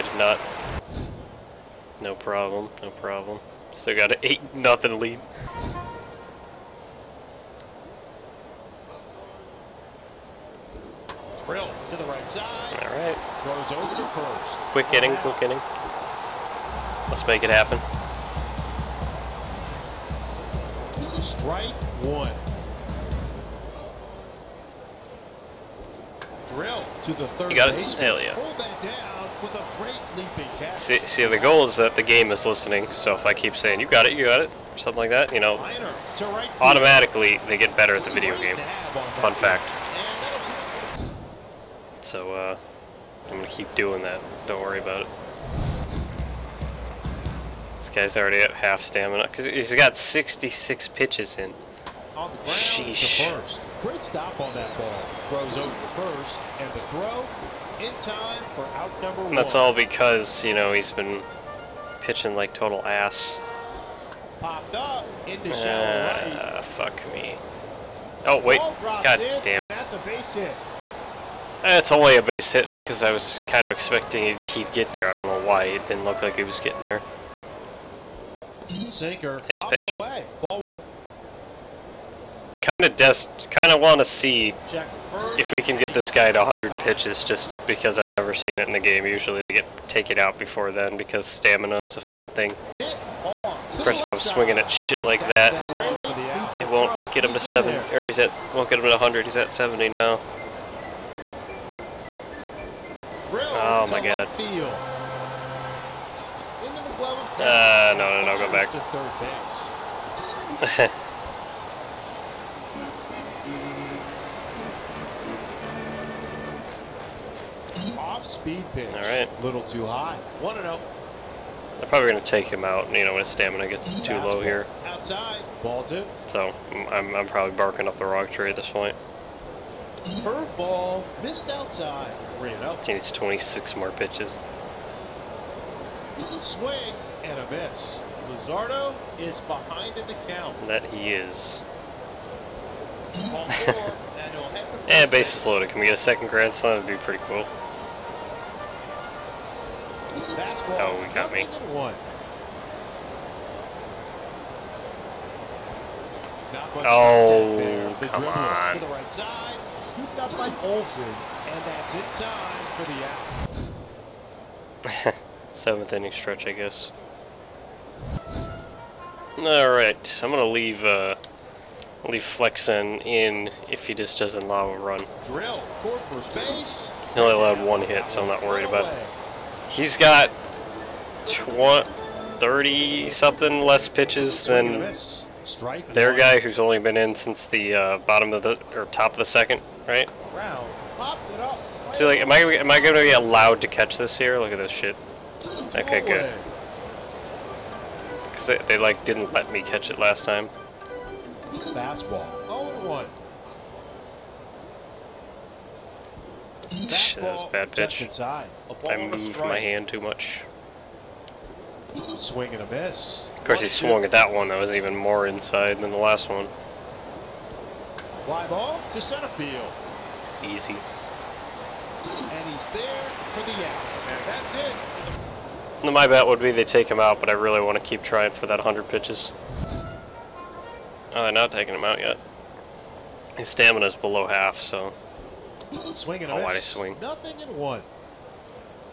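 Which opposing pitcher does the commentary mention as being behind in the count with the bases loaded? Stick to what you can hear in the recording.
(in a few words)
Luzardo.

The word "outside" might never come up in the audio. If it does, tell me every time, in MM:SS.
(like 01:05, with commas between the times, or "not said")
02:04, 02:11.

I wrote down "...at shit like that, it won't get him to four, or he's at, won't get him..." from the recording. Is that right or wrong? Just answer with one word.
wrong.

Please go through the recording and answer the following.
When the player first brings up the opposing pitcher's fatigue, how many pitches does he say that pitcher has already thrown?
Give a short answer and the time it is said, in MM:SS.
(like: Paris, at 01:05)
66, at 00:49.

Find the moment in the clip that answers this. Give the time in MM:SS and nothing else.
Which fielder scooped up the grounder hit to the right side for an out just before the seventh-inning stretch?
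02:40.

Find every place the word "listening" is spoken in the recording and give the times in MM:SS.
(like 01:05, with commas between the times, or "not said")
00:32.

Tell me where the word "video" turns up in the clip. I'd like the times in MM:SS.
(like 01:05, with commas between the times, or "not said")
00:38.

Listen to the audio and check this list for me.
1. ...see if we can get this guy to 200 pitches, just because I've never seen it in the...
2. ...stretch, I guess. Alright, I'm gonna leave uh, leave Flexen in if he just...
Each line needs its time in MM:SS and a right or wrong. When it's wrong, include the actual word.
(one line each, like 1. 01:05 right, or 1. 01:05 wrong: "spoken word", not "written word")
1. 01:24 wrong: "100", not "200"
2. 02:46 right.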